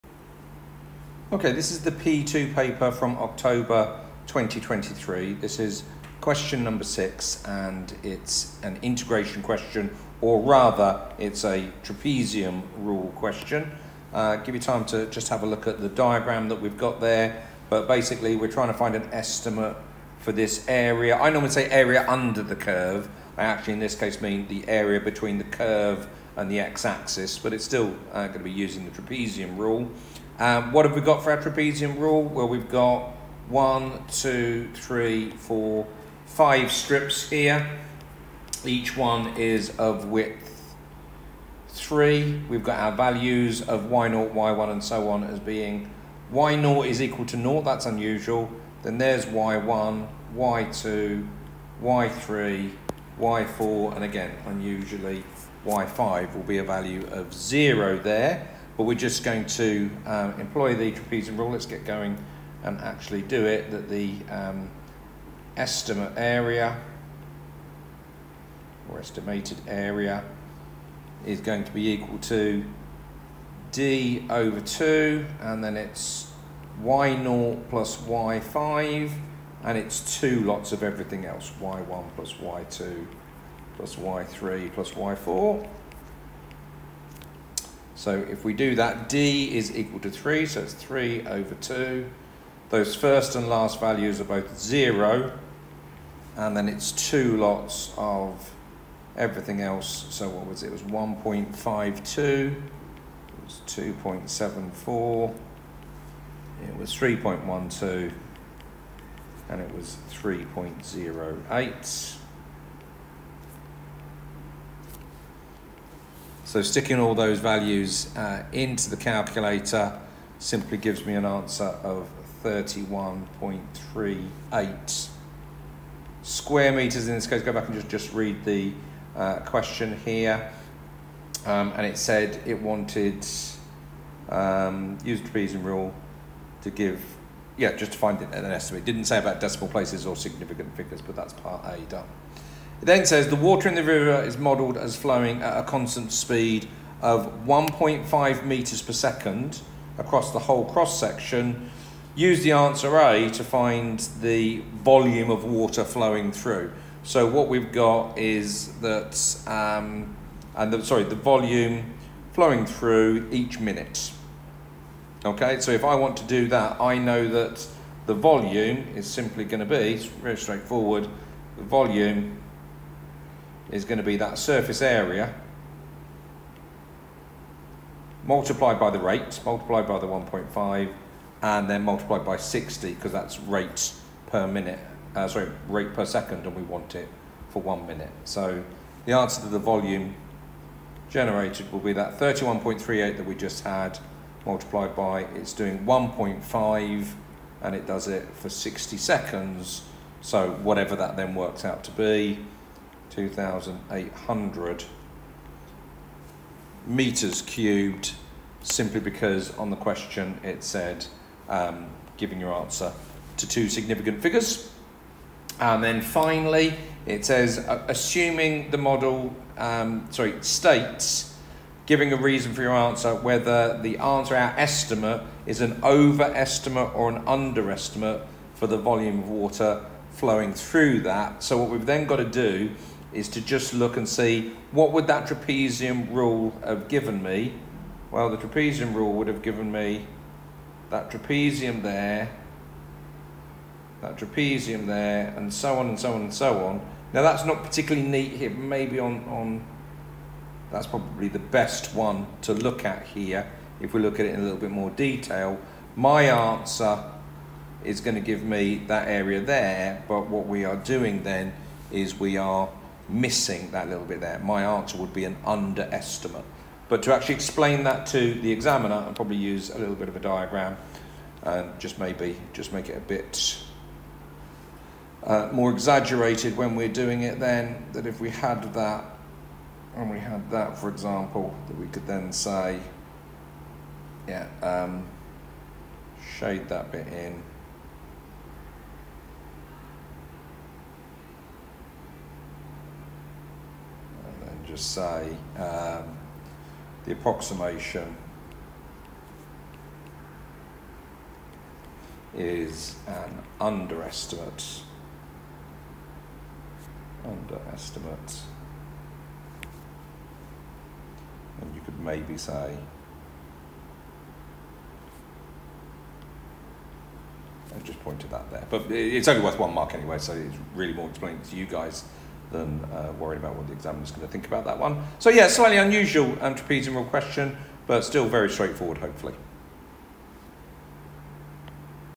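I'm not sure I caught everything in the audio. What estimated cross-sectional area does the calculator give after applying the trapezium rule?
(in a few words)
31.38 square meters.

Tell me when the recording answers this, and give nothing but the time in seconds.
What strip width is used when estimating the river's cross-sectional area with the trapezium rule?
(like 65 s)
38 s.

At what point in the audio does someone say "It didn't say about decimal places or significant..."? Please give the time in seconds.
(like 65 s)
138 s.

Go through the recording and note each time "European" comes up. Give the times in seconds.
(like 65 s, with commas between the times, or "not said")
not said.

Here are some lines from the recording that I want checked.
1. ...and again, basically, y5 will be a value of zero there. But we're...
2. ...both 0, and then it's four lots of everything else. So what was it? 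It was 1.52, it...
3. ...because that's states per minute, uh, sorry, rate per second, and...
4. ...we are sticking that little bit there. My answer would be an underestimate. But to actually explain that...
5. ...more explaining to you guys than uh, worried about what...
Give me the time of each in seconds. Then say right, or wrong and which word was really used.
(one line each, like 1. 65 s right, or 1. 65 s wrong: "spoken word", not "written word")
1. 53 s wrong: "unusually", not "basically"
2. 94 s wrong: "two", not "four"
3. 182 s wrong: "rates", not "states"
4. 262 s wrong: "missing", not "sticking"
5. 320 s right.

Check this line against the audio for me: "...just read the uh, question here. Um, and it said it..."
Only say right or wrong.
right.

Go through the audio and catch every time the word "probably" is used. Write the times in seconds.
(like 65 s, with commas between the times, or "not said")
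250 s, 269 s.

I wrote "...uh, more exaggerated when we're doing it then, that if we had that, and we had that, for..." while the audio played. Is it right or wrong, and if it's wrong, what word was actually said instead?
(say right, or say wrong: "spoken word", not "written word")
right.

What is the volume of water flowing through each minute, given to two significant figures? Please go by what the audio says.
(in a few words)
2,800 cubic meters.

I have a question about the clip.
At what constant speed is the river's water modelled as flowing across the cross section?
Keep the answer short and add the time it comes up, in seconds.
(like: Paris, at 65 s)
1.5 metres per second, at 147 s.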